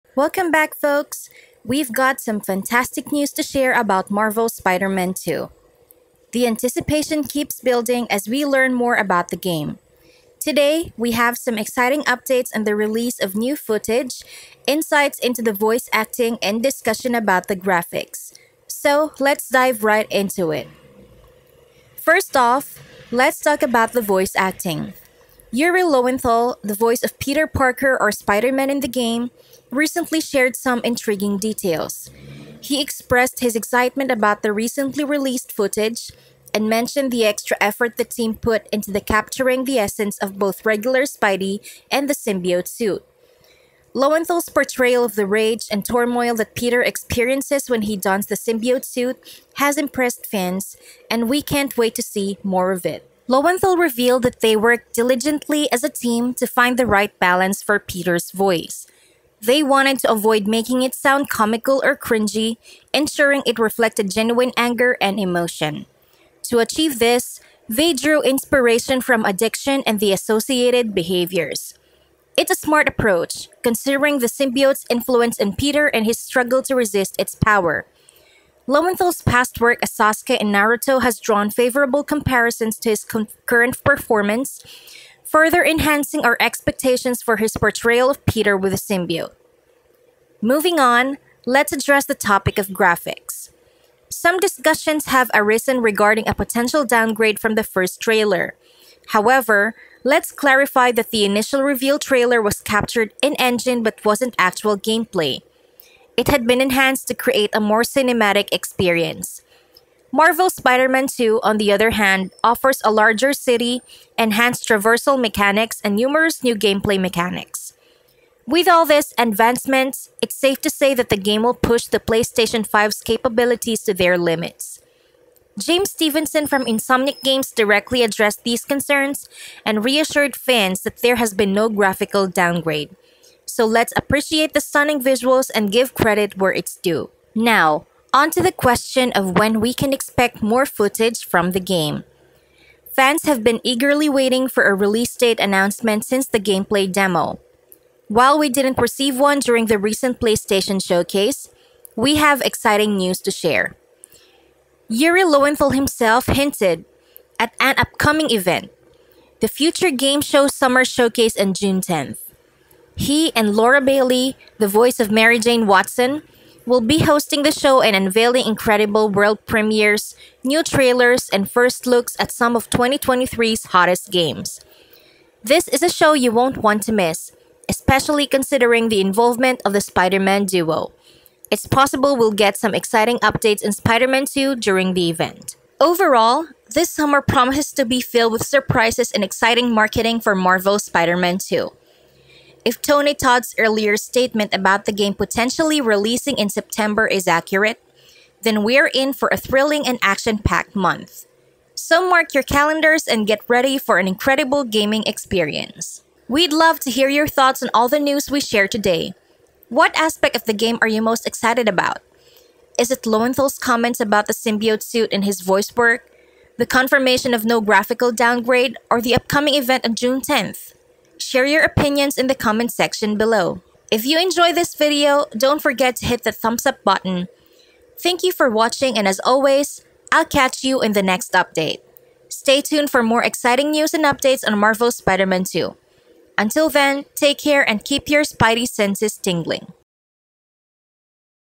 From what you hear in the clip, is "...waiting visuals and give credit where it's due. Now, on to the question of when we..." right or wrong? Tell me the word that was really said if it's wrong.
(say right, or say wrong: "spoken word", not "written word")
wrong: "stunning", not "waiting".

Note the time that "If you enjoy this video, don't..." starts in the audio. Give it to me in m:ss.
3:43.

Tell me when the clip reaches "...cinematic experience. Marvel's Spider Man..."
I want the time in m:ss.
1:47.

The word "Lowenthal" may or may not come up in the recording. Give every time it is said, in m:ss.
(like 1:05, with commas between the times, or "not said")
0:25, 0:43, 0:53, 1:18, 2:35, 3:33.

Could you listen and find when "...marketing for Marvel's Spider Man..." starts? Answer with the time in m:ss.
3:09.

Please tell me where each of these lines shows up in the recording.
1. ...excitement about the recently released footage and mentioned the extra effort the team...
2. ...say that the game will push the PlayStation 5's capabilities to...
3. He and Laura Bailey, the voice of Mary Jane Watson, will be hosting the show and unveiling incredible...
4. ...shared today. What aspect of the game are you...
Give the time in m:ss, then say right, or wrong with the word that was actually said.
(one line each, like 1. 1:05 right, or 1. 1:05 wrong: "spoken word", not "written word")
1. 0:33 right
2. 2:00 right
3. 2:42 right
4. 3:28 right.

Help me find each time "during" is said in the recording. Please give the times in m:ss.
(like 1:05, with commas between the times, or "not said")
2:29, 3:04.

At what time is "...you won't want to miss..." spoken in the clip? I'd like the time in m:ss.
2:56.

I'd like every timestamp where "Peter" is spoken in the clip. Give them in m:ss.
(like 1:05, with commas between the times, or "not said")
0:27, 0:46, 0:57, 1:15, 1:28.